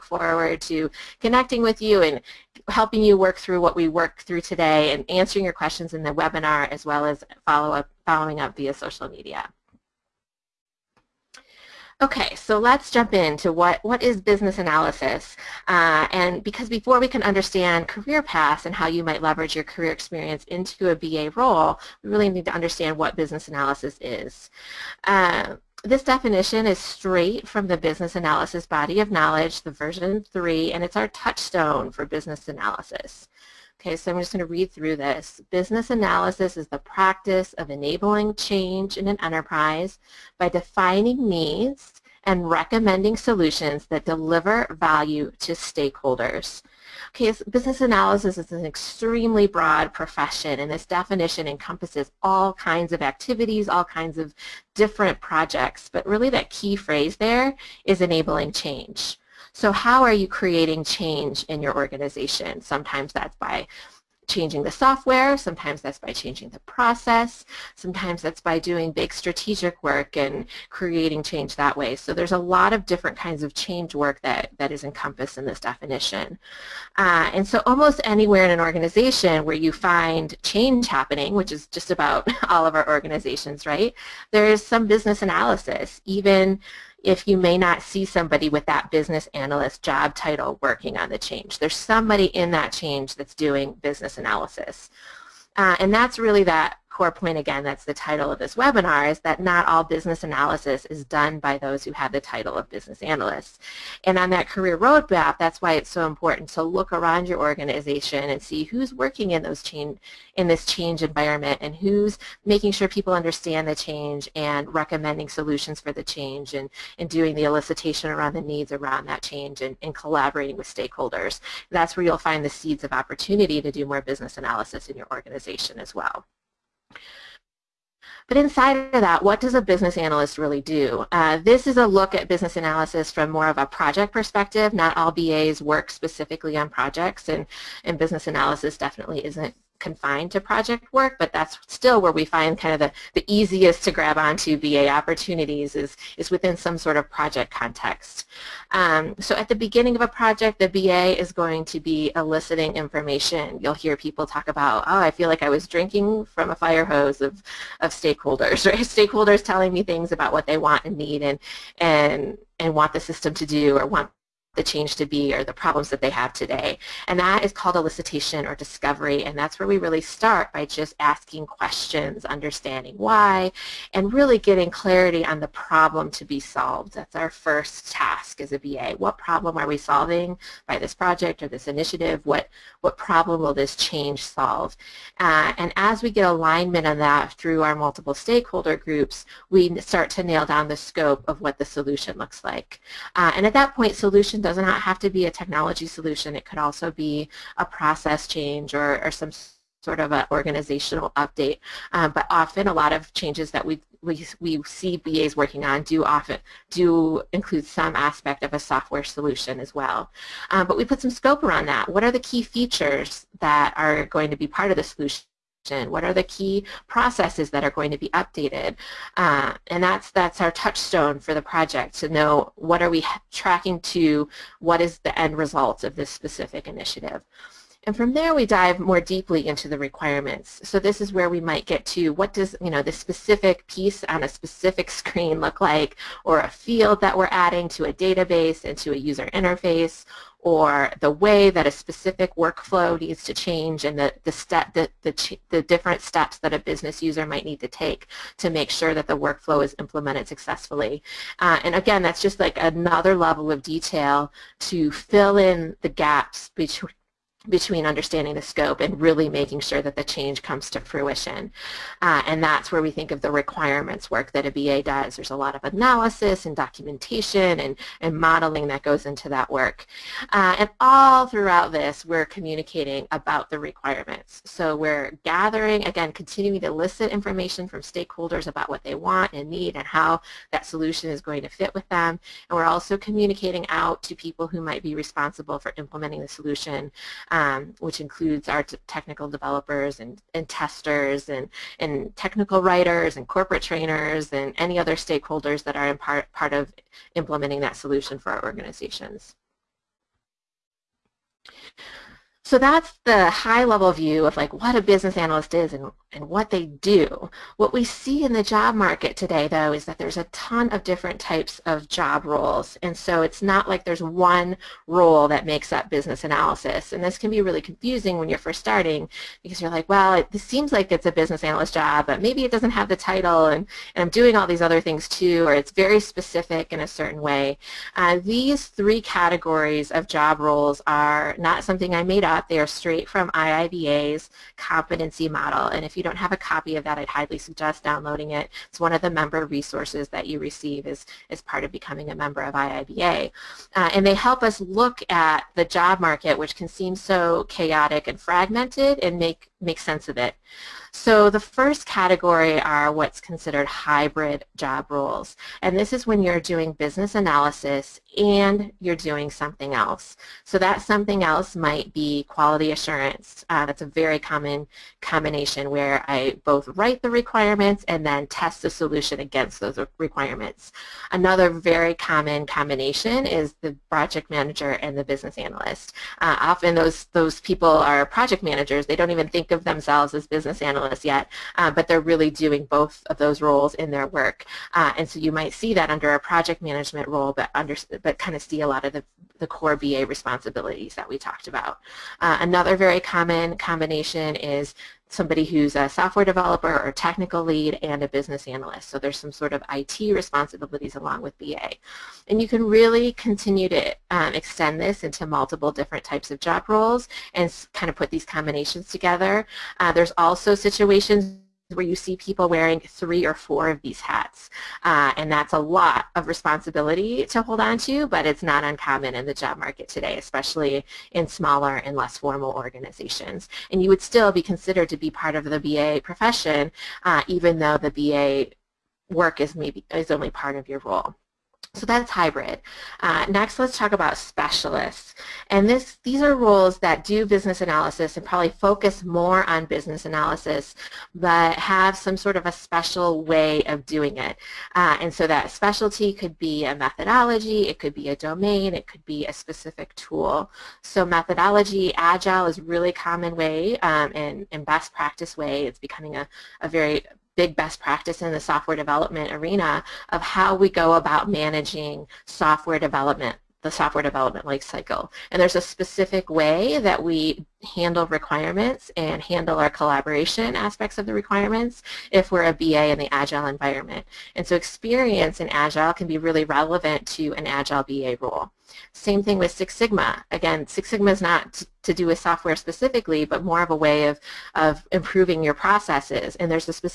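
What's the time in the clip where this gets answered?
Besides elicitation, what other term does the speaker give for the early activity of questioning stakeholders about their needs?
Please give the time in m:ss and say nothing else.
2:48.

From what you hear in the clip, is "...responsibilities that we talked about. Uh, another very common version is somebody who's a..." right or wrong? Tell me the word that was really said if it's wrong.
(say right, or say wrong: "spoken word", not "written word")
wrong: "combination", not "version".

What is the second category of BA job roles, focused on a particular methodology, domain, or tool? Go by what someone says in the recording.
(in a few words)
specialists.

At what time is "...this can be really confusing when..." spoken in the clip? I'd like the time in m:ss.
5:17.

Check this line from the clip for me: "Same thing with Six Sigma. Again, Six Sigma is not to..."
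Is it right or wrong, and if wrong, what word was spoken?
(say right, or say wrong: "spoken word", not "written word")
right.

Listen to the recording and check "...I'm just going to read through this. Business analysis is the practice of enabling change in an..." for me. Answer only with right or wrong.
right.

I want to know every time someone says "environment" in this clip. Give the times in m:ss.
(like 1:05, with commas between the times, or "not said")
1:51, 7:53.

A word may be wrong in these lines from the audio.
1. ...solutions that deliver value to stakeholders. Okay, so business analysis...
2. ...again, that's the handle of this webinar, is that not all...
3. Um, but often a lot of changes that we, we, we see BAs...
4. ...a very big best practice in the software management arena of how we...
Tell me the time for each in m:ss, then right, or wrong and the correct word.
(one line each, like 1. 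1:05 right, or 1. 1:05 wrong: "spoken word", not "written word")
1. 0:43 right
2. 1:37 wrong: "title", not "handle"
3. 3:21 right
4. 7:36 wrong: "development", not "management".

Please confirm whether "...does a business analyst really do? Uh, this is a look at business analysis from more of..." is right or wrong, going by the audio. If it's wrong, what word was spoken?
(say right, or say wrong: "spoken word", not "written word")
right.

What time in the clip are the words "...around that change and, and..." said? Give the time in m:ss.
1:58.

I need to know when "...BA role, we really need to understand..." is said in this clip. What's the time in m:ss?
0:20.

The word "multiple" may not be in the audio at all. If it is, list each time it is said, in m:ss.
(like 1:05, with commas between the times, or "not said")
3:07, 6:45.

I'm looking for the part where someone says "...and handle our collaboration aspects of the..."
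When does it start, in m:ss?
7:48.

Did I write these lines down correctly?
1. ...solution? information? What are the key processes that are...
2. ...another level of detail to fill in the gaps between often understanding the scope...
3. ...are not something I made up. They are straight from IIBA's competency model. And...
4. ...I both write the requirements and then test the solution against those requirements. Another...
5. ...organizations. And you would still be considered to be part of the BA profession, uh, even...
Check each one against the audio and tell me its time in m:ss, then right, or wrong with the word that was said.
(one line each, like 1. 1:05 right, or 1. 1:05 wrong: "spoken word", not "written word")
1. 3:34 right
2. 4:12 wrong: "between", not "often"
3. 5:30 right
4. 6:06 right
5. 7:02 right.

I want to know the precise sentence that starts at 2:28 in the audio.
Um, so at the beginning of a project, the BA is going to be eliciting information.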